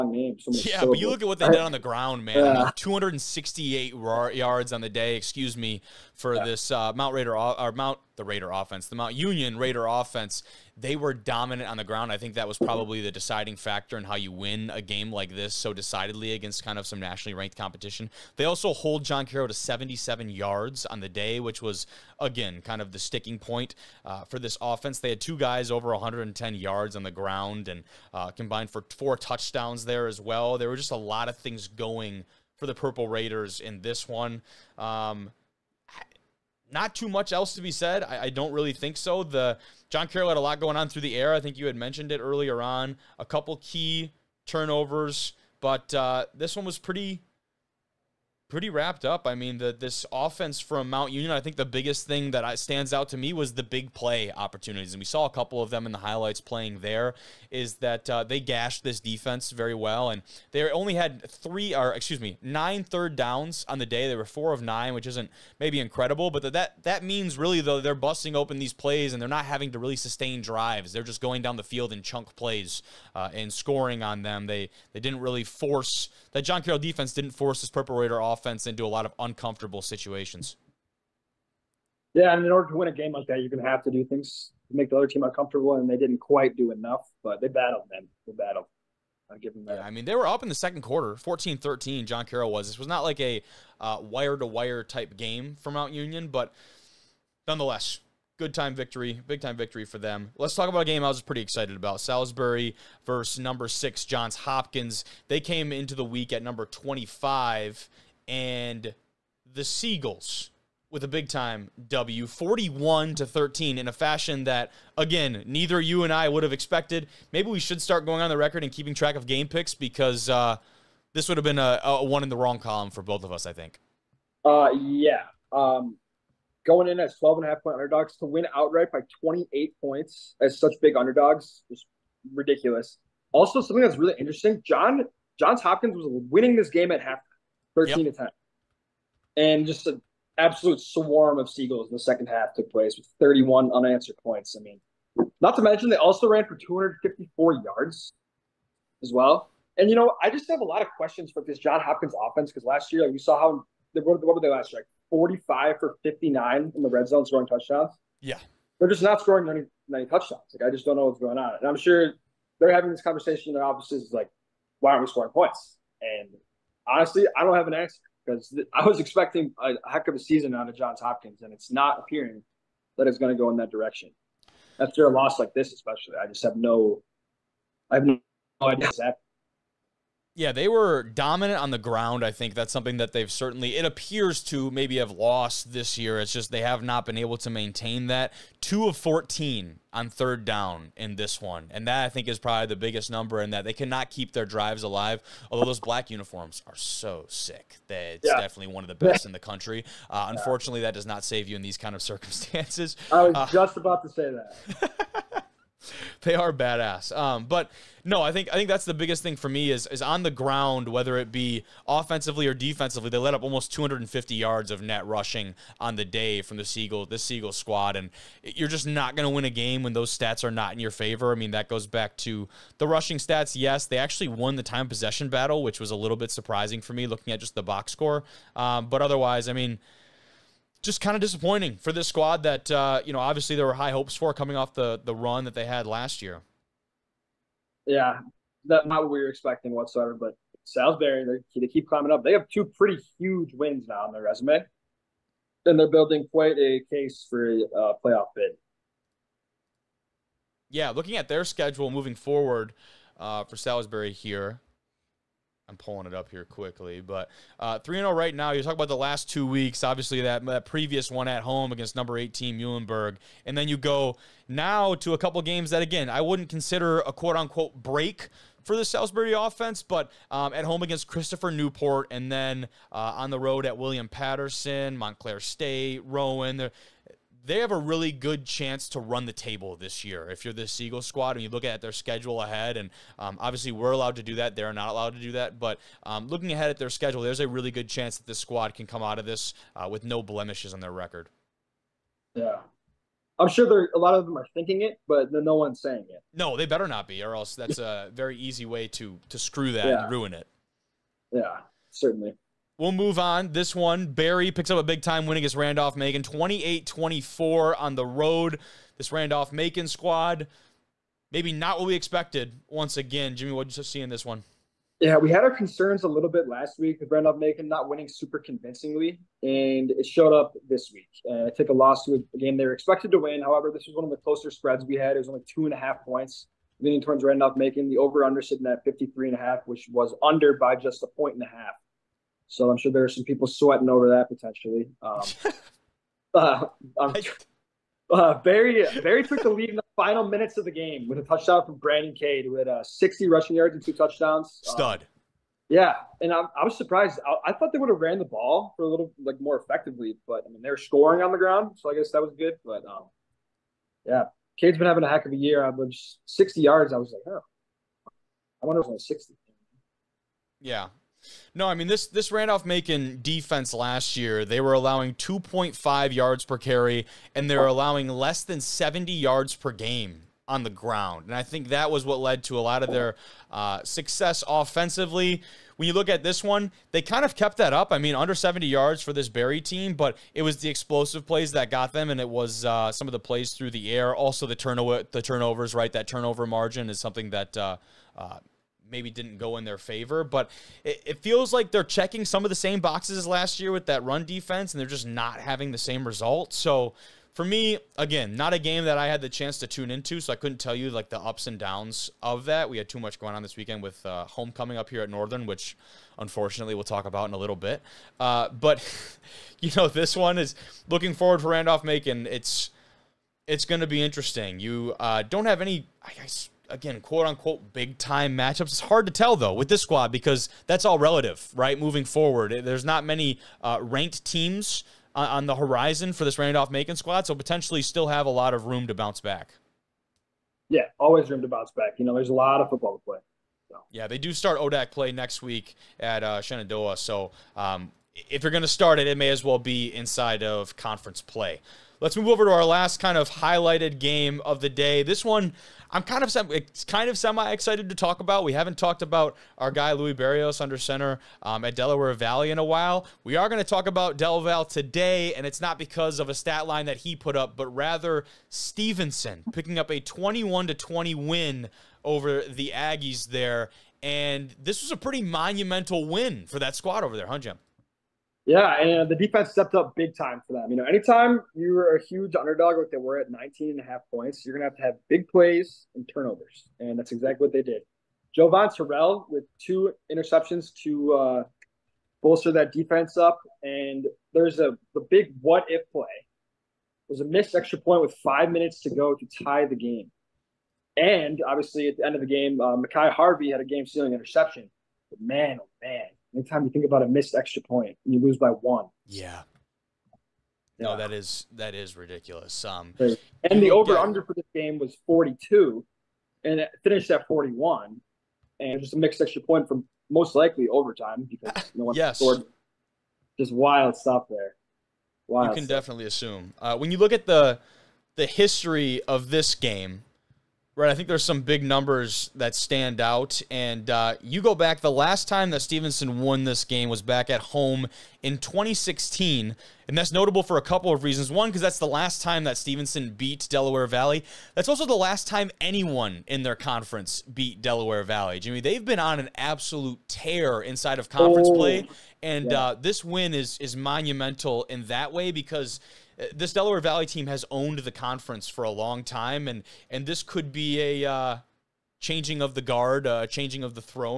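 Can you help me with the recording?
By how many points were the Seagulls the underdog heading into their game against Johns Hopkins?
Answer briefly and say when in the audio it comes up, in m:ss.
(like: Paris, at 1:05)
12 and a half, at 2:07.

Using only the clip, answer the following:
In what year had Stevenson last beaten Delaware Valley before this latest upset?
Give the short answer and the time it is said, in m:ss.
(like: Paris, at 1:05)
2016, at 8:48.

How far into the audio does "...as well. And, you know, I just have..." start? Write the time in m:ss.
2:29.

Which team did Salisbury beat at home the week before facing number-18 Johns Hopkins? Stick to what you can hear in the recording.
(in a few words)
Muhlenberg.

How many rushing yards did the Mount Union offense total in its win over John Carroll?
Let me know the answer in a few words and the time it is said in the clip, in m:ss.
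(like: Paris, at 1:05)
268, at 0:02.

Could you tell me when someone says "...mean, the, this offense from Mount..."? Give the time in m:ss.
0:49.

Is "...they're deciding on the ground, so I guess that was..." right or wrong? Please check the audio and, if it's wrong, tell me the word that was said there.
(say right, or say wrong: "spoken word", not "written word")
wrong: "scoring", not "deciding".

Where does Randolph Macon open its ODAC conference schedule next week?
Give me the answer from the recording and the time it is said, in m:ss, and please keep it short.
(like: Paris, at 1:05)
Shenandoah, at 7:16.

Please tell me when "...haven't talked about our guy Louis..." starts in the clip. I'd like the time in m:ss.
7:28.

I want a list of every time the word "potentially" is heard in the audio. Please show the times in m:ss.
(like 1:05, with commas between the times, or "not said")
5:34, 7:07.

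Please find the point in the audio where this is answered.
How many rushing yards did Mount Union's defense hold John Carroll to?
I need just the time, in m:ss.
0:19.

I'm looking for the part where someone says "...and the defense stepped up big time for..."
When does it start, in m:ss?
7:48.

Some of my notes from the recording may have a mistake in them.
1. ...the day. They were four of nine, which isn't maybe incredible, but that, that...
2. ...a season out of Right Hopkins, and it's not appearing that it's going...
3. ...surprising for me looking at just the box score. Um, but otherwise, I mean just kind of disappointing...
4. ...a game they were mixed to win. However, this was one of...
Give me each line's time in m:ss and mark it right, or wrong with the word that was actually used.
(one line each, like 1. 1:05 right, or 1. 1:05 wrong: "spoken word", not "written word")
1. 1:03 right
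2. 2:50 wrong: "Johns", not "Right"
3. 3:46 right
4. 5:22 wrong: "expected", not "mixed".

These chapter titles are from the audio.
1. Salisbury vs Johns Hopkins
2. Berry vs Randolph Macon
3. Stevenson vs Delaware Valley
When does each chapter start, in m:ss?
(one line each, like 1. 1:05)
1. 1:40
2. 5:02
3. 7:22.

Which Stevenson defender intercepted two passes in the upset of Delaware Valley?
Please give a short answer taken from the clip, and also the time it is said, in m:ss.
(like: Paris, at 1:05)
Jovan Terrell, at 7:58.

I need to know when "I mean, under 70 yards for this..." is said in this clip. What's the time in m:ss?
6:17.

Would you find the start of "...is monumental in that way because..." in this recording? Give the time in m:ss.
9:03.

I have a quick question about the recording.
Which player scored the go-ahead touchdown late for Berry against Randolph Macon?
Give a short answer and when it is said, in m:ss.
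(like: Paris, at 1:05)
Brandon Cade, at 5:41.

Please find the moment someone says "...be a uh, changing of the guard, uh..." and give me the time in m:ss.
9:10.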